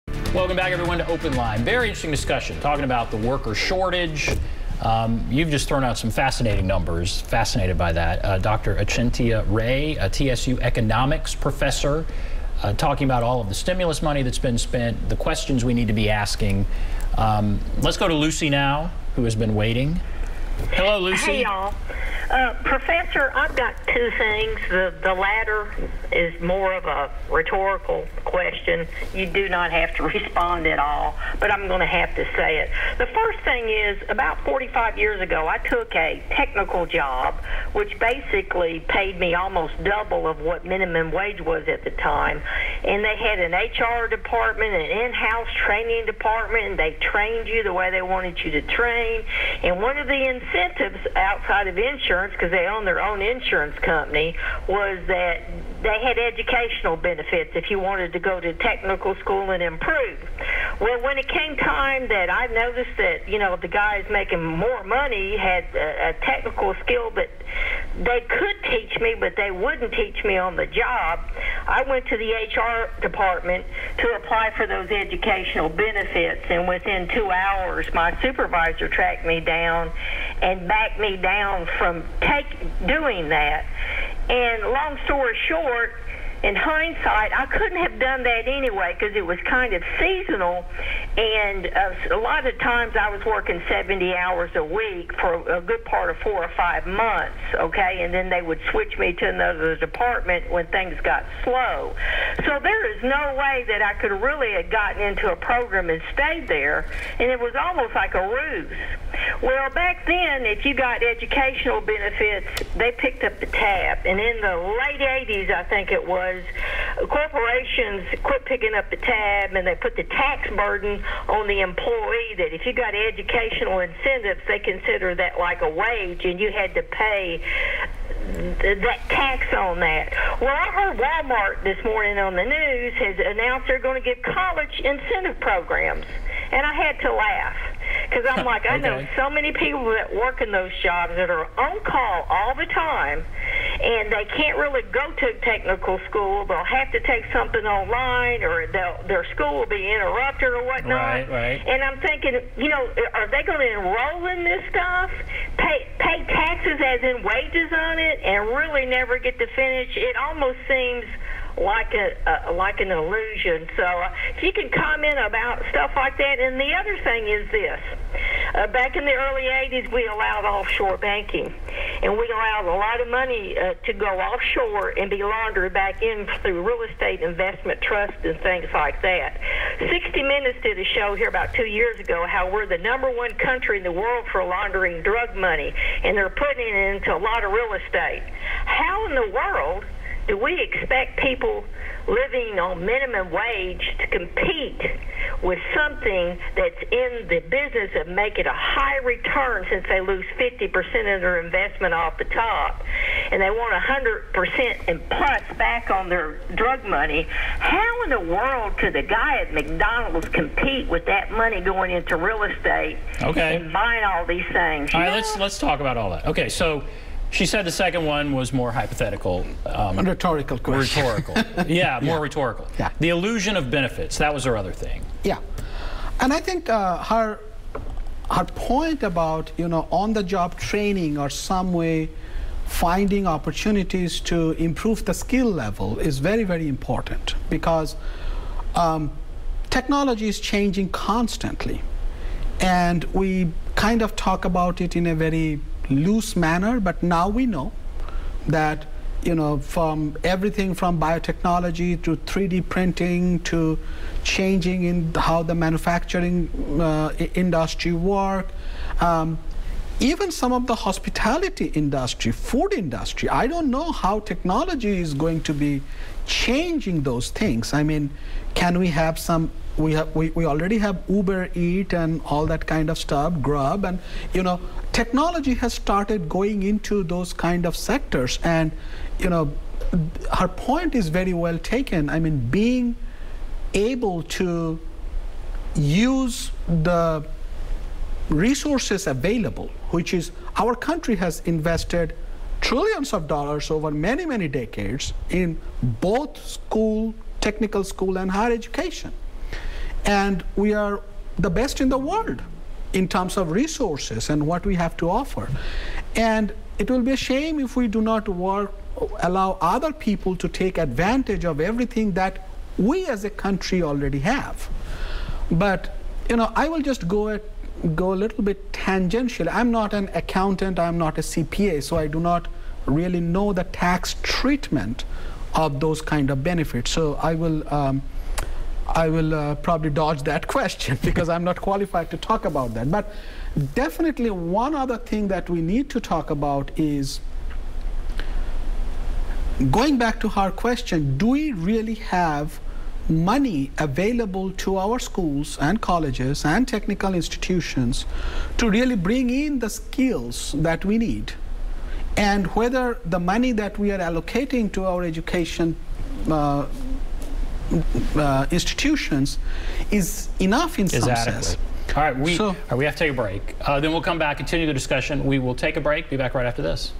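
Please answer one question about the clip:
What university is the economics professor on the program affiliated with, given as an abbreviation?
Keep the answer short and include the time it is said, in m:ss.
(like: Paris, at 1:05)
TSU, at 0:10.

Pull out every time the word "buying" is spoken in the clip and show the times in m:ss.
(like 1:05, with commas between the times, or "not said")
3:33.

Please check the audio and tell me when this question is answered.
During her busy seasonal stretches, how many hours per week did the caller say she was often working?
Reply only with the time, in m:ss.
1:33.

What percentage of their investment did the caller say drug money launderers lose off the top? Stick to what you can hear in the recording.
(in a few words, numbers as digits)
50%.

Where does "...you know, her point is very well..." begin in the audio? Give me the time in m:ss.
4:39.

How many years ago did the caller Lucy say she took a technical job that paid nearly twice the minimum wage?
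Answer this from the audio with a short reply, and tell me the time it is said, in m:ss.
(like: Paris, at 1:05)
45, at 0:34.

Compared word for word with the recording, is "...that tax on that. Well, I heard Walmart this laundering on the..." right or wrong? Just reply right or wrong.
wrong.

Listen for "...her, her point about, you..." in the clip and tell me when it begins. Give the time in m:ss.
3:46.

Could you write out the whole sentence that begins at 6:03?
Uh, then we'll come back, continue the discussion.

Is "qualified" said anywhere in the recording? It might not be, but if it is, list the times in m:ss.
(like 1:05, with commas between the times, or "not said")
5:31.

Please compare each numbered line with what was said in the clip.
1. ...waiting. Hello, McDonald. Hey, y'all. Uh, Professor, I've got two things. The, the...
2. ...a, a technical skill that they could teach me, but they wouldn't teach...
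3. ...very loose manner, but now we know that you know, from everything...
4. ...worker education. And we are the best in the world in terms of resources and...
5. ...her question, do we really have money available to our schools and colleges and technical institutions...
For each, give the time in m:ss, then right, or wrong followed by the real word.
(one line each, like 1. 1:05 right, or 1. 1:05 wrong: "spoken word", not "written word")
1. 0:19 wrong: "Lucy", not "McDonald"
2. 1:05 right
3. 4:05 right
4. 4:58 wrong: "higher", not "worker"
5. 5:40 right.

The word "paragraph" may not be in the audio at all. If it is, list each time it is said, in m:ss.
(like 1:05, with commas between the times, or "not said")
not said.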